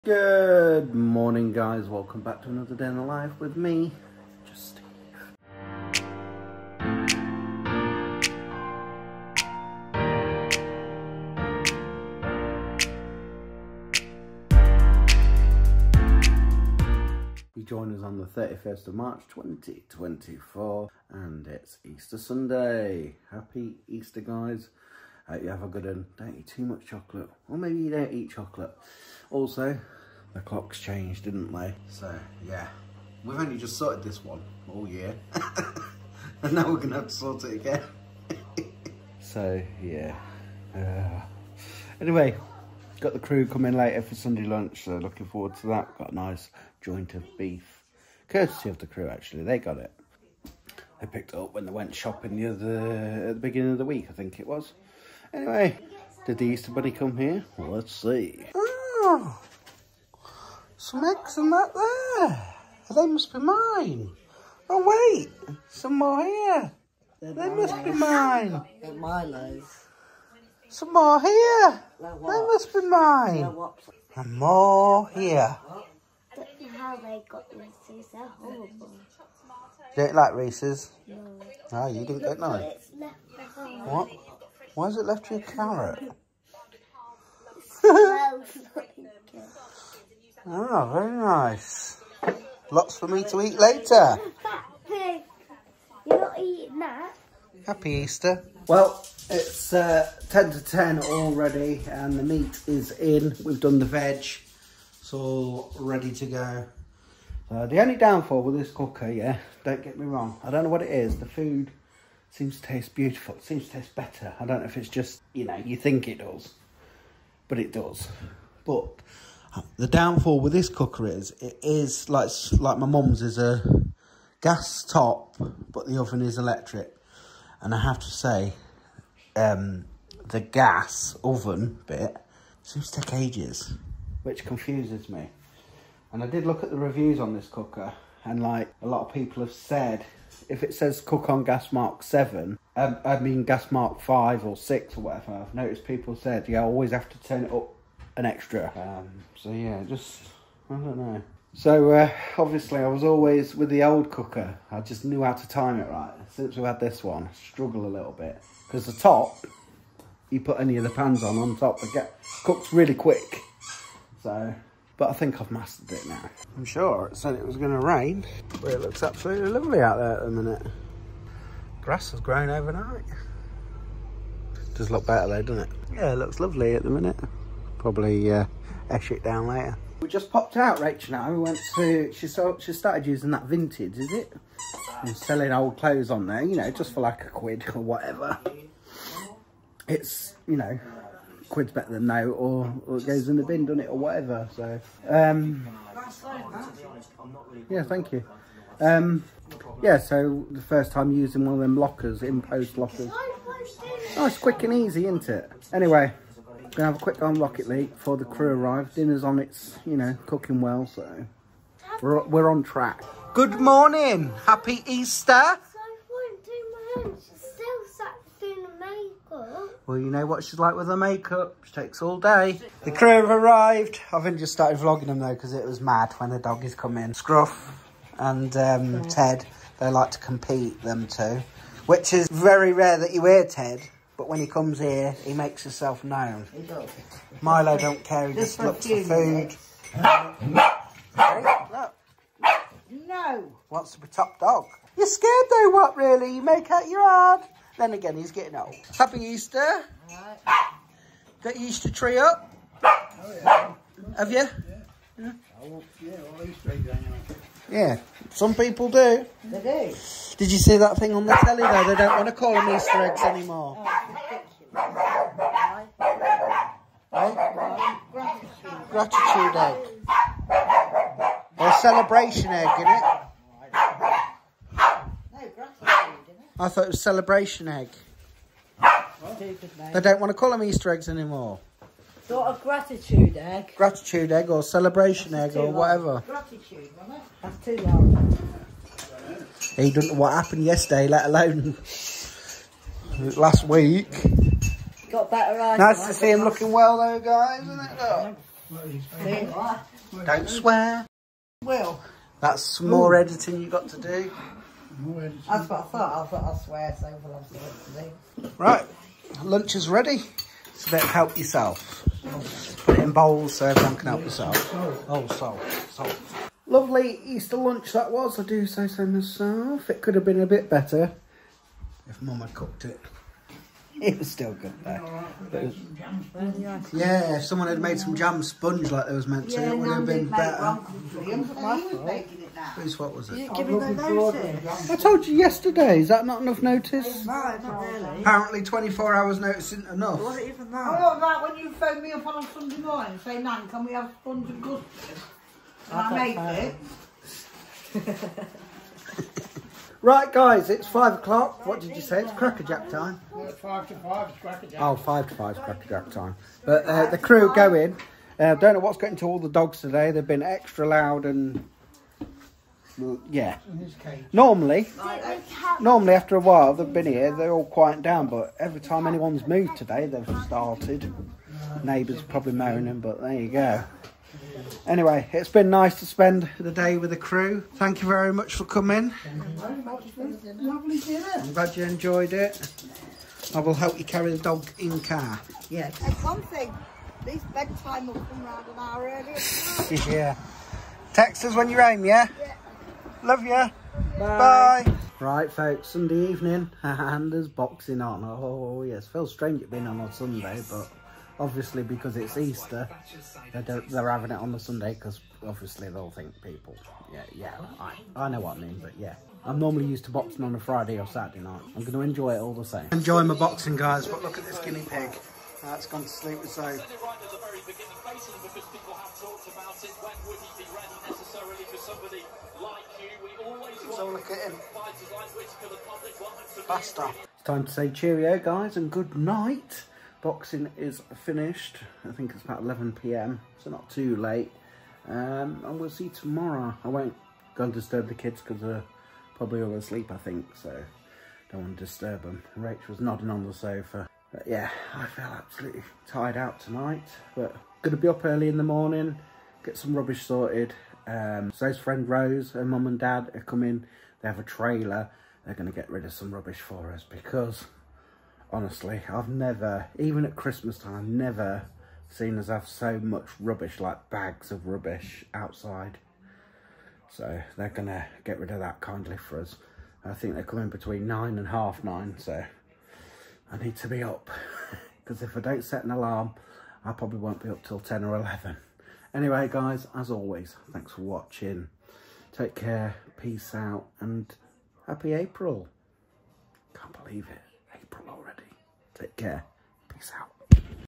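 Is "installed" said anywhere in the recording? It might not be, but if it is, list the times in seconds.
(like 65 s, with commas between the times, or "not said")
not said.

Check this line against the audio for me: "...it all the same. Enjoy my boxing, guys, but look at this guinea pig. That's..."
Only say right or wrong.
right.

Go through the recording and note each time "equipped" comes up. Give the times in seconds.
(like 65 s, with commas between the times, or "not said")
not said.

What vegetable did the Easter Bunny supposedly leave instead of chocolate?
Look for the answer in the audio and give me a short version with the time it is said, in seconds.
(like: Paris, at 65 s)
A carrot, at 85 s.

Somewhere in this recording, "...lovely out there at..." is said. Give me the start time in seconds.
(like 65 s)
169 s.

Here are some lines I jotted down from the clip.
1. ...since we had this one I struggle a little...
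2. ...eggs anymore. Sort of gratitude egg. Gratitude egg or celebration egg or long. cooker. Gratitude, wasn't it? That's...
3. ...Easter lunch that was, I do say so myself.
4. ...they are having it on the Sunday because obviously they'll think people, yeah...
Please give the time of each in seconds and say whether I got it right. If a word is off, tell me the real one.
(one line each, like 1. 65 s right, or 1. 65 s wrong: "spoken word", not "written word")
1. 156 s right
2. 280 s wrong: "whatever", not "cooker"
3. 317 s right
4. 403 s right.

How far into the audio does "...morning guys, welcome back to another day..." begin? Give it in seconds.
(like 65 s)
0 s.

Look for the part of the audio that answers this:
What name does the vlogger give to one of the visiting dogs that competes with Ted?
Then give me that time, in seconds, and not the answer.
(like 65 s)
227 s.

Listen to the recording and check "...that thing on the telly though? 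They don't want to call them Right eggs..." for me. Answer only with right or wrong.
wrong.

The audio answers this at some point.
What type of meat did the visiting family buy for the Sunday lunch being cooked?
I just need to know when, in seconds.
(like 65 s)
46 s.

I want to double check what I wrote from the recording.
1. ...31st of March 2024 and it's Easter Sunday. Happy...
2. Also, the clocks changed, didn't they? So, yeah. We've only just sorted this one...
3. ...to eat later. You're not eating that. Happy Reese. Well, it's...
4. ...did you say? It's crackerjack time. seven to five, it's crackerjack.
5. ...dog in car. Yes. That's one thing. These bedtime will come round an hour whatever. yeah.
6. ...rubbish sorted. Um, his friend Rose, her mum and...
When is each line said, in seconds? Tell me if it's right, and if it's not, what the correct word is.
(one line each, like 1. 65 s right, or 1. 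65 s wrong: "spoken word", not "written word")
1. 18 s right
2. 29 s right
3. 93 s wrong: "Easter", not "Reese"
4. 351 s wrong: "five", not "seven"
5. 384 s wrong: "earlier", not "whatever"
6. 449 s right.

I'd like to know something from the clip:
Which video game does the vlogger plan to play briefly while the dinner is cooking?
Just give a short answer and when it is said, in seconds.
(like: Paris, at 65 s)
Rocket League, at 207 s.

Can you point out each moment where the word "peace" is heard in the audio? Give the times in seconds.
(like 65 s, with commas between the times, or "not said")
483 s, 489 s.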